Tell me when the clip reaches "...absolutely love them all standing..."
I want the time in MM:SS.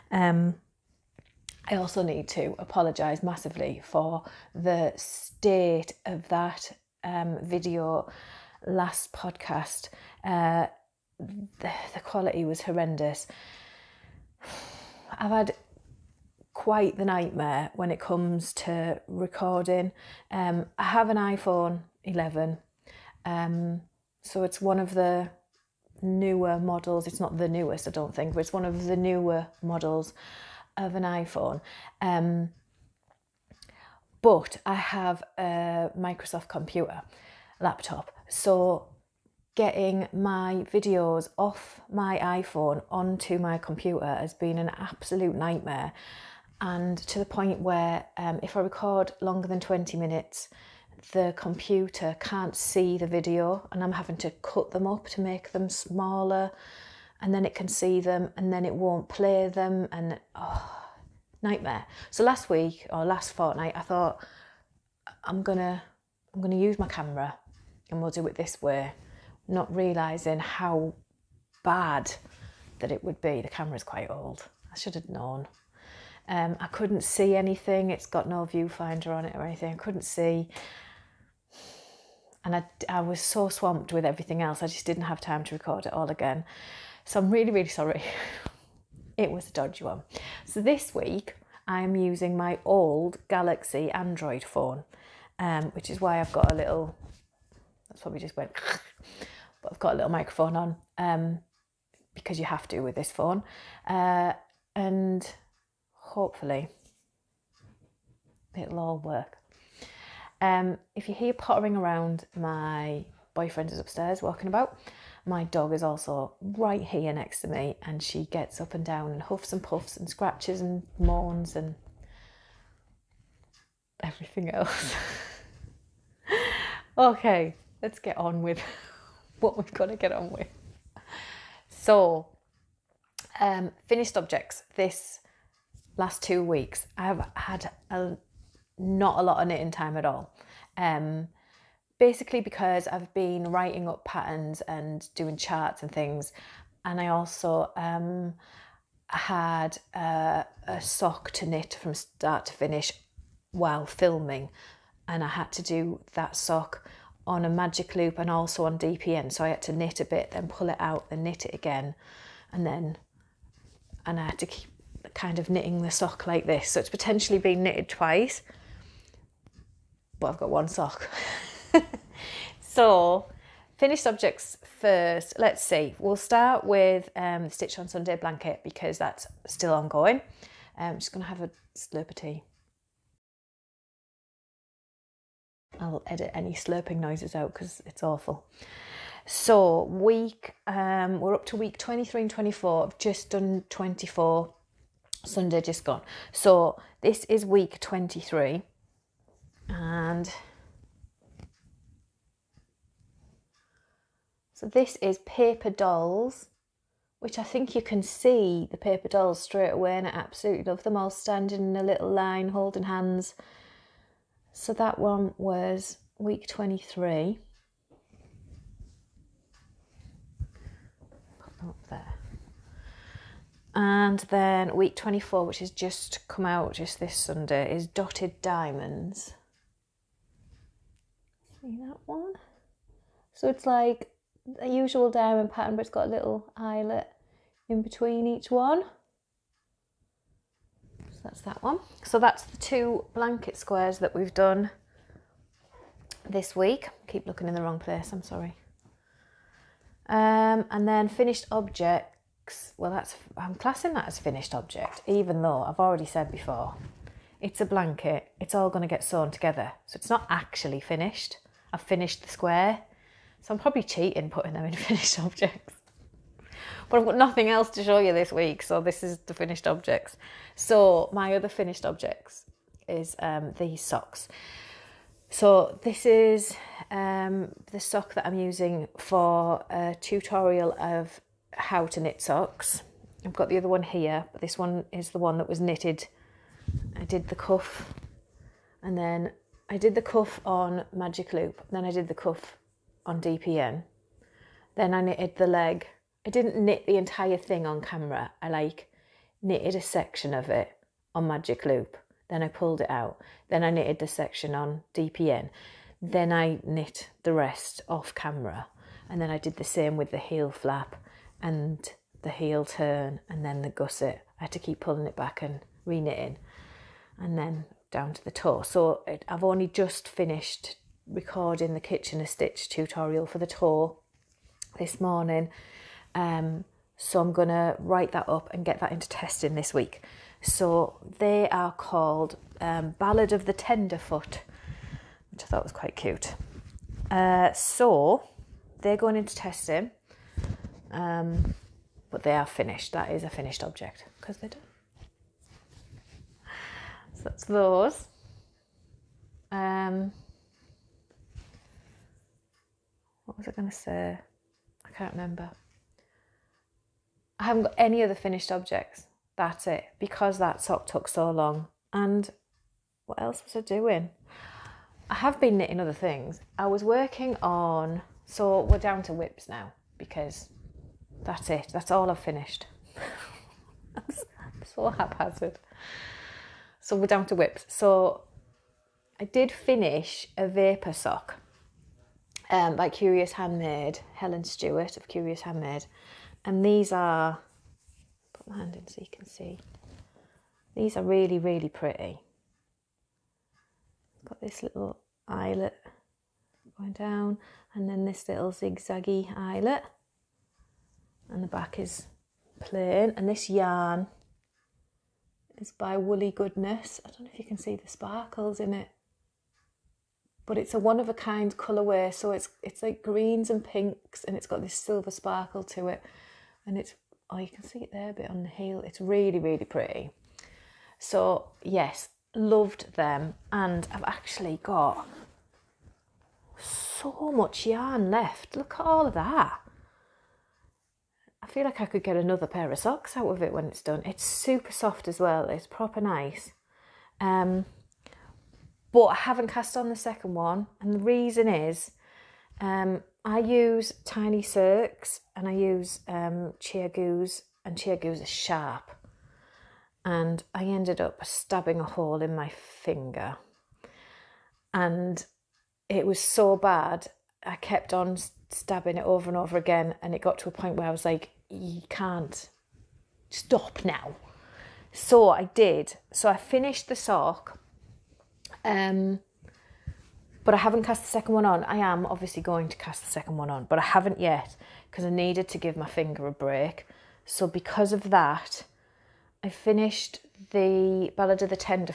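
03:30.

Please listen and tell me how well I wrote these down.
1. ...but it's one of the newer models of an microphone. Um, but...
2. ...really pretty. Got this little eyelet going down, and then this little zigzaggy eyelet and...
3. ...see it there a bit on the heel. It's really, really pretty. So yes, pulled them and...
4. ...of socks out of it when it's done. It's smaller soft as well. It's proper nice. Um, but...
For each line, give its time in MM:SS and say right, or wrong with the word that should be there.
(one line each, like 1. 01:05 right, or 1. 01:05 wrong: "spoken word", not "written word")
1. 00:28 wrong: "iPhone", not "microphone"
2. 06:31 right
3. 06:57 wrong: "loved", not "pulled"
4. 07:12 wrong: "super", not "smaller".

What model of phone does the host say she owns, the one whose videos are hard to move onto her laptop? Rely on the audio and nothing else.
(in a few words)
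iPhone 11.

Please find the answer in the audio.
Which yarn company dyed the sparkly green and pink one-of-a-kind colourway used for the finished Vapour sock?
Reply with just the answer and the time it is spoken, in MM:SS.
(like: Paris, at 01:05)
Woolly Goodness, at 06:45.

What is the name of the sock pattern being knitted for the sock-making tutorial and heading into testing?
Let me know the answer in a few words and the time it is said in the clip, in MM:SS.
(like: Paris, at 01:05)
Ballad of the Tenderfoot, at 05:32.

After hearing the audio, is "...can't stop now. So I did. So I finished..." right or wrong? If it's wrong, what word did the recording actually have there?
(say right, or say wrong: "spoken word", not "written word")
right.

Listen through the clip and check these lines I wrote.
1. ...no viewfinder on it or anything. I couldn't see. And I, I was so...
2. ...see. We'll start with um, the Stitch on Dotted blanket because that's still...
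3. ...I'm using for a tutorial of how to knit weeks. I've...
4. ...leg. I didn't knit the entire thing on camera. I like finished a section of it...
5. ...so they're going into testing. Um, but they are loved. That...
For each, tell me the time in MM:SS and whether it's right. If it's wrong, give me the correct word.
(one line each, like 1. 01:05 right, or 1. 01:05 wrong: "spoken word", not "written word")
1. 01:18 right
2. 02:55 wrong: "Sunday", not "Dotted"
3. 04:38 wrong: "socks", not "weeks"
4. 04:55 wrong: "knitted", not "finished"
5. 05:37 wrong: "finished", not "loved".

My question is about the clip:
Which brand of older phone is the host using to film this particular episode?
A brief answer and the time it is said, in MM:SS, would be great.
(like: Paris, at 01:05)
Galaxy, at 01:33.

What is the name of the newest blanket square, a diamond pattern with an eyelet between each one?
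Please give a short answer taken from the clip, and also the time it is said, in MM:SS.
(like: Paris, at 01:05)
Dotted Diamonds, at 03:47.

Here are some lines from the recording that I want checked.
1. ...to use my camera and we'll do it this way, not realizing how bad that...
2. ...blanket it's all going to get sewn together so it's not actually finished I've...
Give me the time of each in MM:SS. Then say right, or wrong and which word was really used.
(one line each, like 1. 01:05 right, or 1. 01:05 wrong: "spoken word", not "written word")
1. 01:06 right
2. 04:17 right.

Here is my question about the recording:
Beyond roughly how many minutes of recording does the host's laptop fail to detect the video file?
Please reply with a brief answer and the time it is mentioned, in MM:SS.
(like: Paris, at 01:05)
20, at 00:49.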